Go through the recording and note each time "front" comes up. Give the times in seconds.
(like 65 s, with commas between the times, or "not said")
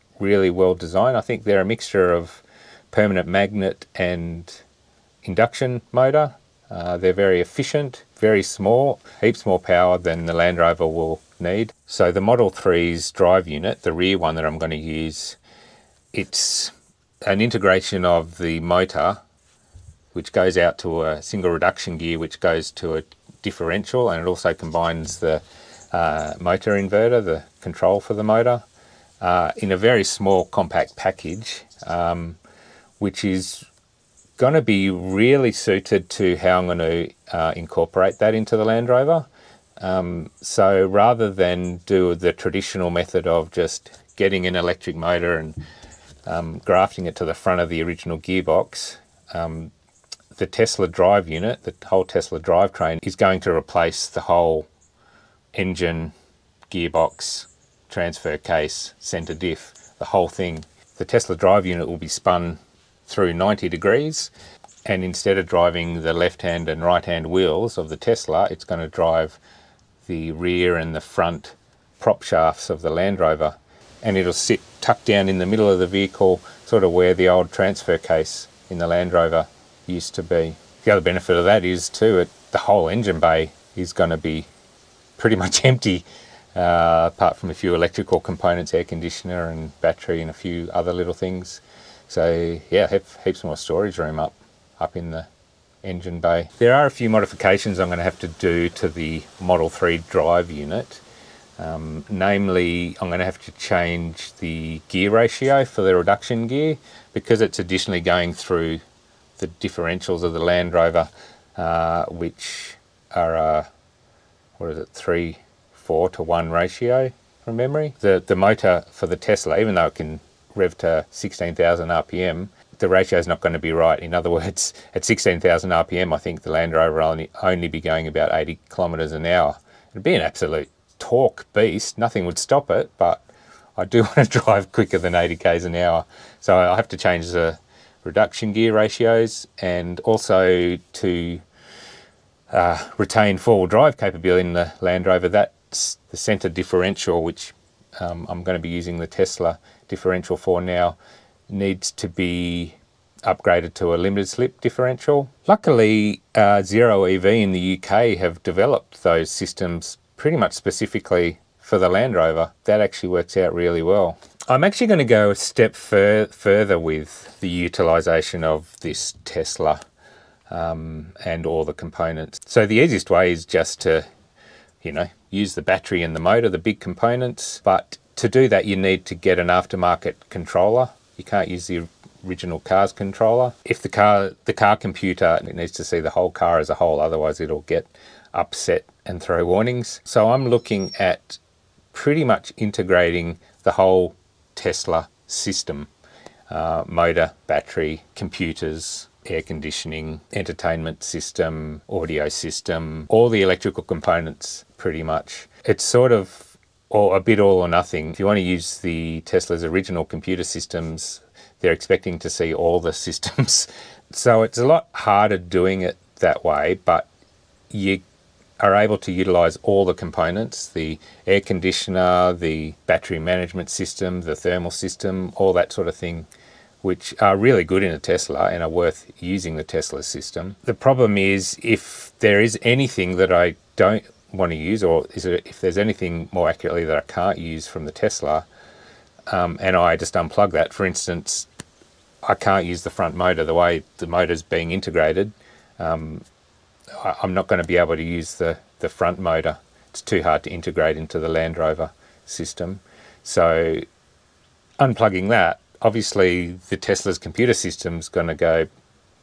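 47 s, 70 s, 242 s, 248 s.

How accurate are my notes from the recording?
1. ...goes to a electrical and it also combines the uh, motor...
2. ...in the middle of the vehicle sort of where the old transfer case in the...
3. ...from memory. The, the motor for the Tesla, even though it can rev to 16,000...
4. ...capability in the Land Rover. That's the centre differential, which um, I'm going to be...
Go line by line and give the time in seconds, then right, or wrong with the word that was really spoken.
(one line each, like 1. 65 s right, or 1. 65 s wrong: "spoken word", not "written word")
1. 22 s wrong: "differential", not "electrical"
2. 75 s right
3. 117 s right
4. 143 s right.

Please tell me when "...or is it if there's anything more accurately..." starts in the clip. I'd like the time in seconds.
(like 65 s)
234 s.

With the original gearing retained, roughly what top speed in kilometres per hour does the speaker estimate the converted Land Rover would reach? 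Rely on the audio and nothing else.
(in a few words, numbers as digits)
80 km/h.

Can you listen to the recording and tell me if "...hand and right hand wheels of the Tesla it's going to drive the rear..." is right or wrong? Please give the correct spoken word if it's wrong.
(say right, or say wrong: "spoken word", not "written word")
right.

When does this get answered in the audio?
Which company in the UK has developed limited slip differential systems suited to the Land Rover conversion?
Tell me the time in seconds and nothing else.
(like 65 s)
156 s.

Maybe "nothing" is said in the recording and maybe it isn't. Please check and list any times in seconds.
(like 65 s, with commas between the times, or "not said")
131 s, 207 s.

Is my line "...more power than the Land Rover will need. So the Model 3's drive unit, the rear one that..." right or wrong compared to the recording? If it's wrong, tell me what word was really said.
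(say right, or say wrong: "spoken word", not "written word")
right.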